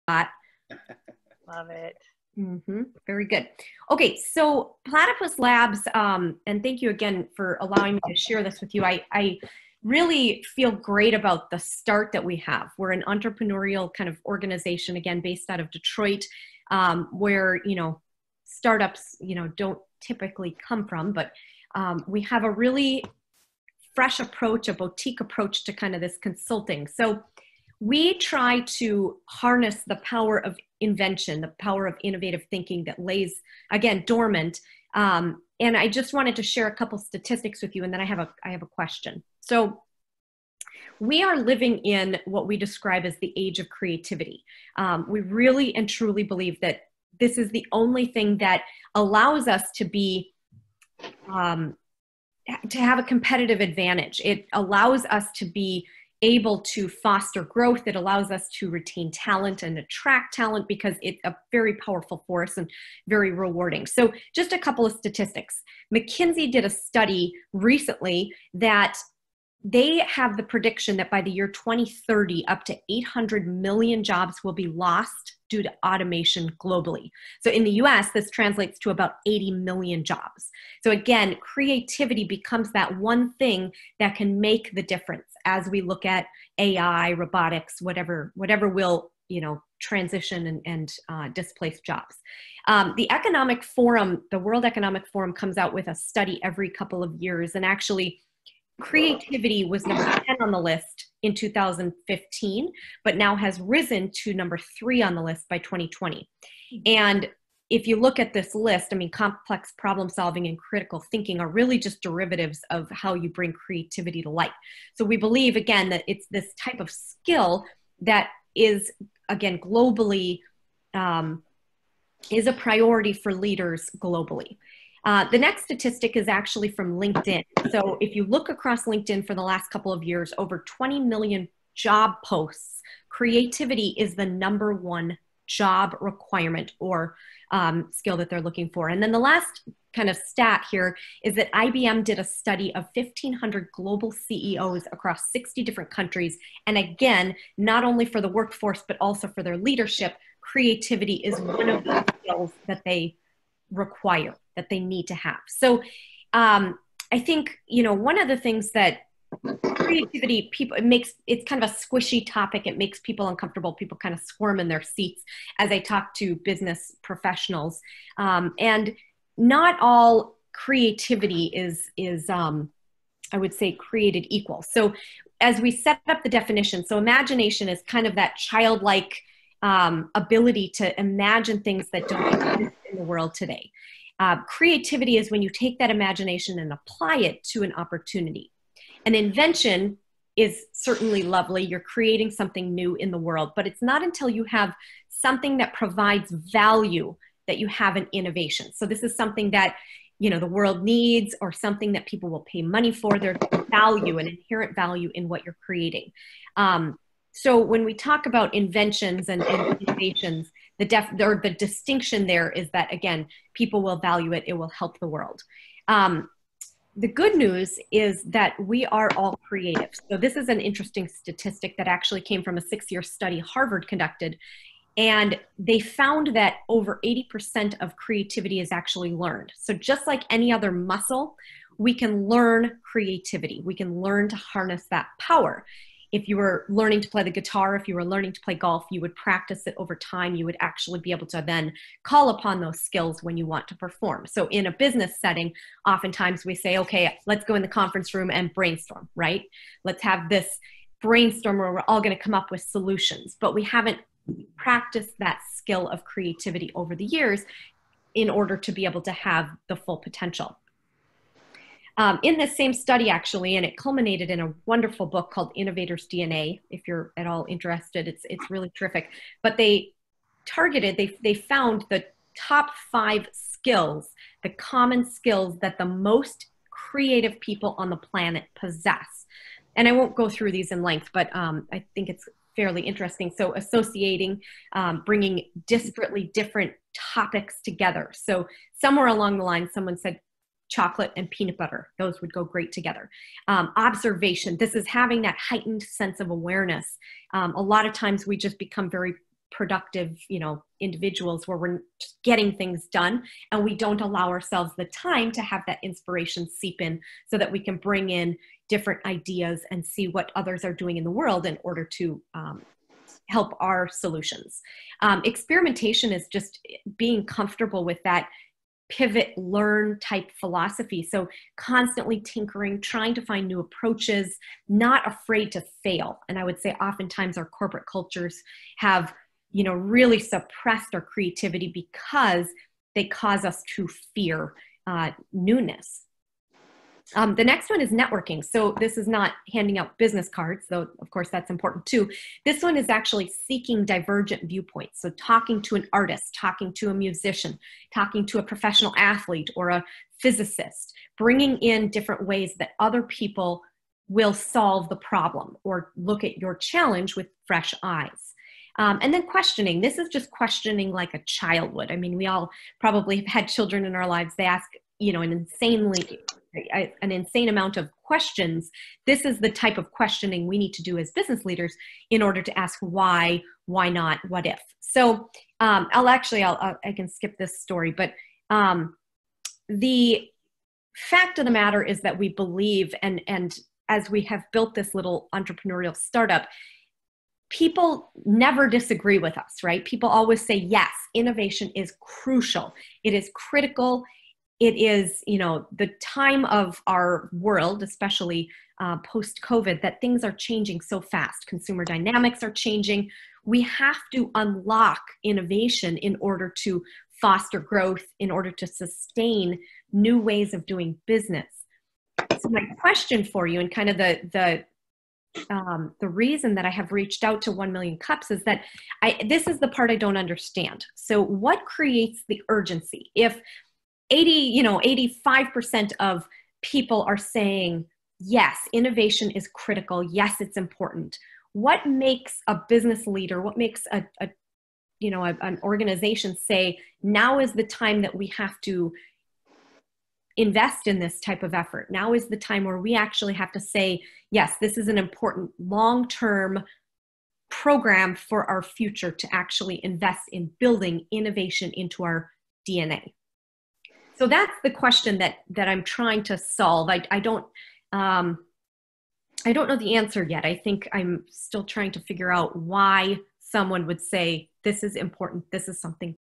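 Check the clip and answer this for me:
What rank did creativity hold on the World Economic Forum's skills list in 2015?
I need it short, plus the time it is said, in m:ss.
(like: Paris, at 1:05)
number 10, at 1:39.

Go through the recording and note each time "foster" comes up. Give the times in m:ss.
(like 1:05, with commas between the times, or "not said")
0:56, 6:47.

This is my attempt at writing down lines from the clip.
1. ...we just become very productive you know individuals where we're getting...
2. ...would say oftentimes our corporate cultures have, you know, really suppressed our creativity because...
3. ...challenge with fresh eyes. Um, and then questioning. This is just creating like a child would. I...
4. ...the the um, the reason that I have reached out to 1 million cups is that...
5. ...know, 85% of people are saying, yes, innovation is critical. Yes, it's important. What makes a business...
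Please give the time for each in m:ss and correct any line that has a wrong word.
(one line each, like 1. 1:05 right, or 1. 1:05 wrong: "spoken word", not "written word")
1. 4:58 right
2. 5:26 right
3. 5:56 wrong: "questioning", not "creating"
4. 6:53 right
5. 7:04 right.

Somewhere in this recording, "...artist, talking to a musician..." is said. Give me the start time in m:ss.
5:45.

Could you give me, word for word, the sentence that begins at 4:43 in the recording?
So, associating, um, bringing disparately different topics together.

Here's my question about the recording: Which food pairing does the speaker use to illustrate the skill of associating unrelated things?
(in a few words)
chocolate and peanut butter.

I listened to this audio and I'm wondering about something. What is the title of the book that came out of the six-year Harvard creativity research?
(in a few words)
Innovators DNA.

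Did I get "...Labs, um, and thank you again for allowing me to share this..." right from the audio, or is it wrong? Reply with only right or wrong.
right.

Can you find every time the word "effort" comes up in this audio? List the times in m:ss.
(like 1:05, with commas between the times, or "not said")
7:21.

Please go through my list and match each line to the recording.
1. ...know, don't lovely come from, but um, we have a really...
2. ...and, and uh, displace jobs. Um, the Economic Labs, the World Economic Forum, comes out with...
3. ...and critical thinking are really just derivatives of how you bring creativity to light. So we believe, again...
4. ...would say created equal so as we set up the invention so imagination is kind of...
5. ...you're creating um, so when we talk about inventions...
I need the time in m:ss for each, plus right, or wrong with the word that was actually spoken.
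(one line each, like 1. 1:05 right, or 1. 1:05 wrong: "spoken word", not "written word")
1. 0:19 wrong: "typically", not "lovely"
2. 1:30 wrong: "Forum", not "Labs"
3. 1:50 right
4. 2:53 wrong: "definition", not "invention"
5. 3:25 right.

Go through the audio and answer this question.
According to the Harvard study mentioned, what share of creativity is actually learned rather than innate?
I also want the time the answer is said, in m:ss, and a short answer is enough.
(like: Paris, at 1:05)
over 80%, at 3:46.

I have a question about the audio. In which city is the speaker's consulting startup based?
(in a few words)
Detroit.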